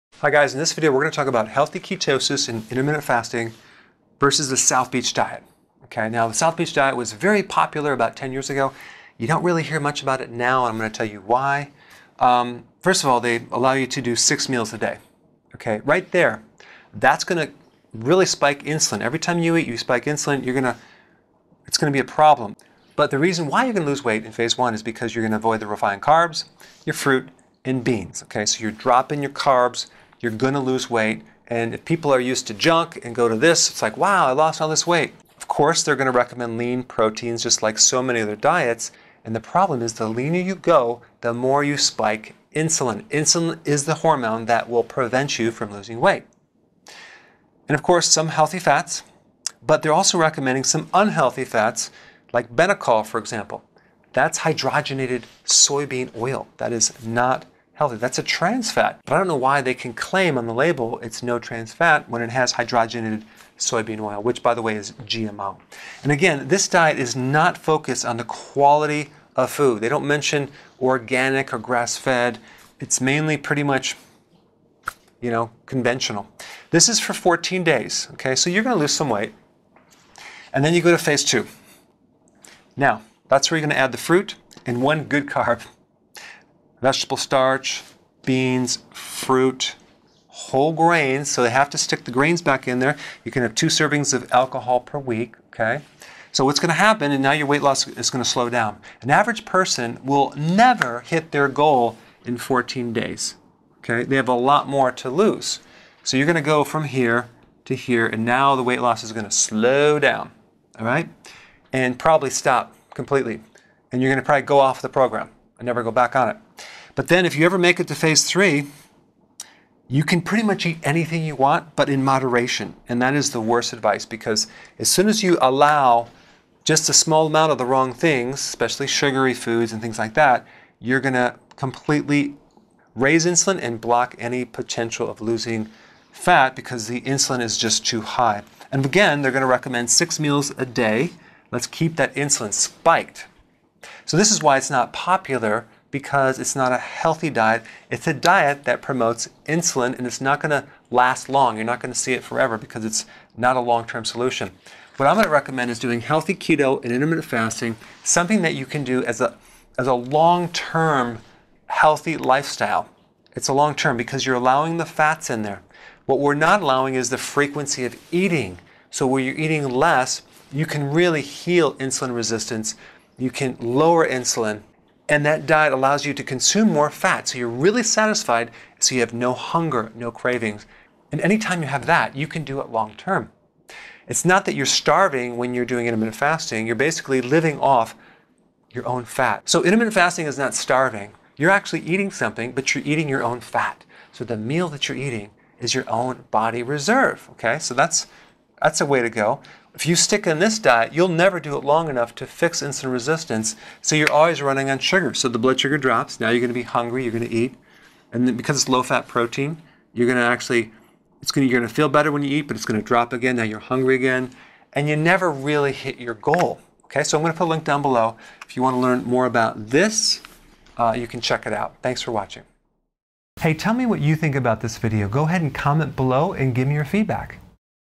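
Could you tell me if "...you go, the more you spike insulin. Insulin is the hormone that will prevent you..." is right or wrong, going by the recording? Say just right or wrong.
right.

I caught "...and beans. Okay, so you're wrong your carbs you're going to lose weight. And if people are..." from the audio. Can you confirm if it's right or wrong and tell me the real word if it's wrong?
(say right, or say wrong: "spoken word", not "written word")
wrong: "dropping", not "wrong".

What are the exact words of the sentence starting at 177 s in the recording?
So you're really satisfied, so you have no hunger, no cravings.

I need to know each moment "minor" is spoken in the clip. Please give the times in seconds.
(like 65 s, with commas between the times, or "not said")
not said.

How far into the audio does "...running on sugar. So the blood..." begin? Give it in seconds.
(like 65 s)
204 s.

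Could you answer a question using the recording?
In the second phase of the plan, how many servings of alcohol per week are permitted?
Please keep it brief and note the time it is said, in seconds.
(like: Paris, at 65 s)
2, at 93 s.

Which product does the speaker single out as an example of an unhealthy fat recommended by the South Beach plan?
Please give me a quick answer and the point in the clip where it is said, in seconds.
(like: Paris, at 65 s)
Benecol, at 52 s.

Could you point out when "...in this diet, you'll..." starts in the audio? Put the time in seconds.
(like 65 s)
200 s.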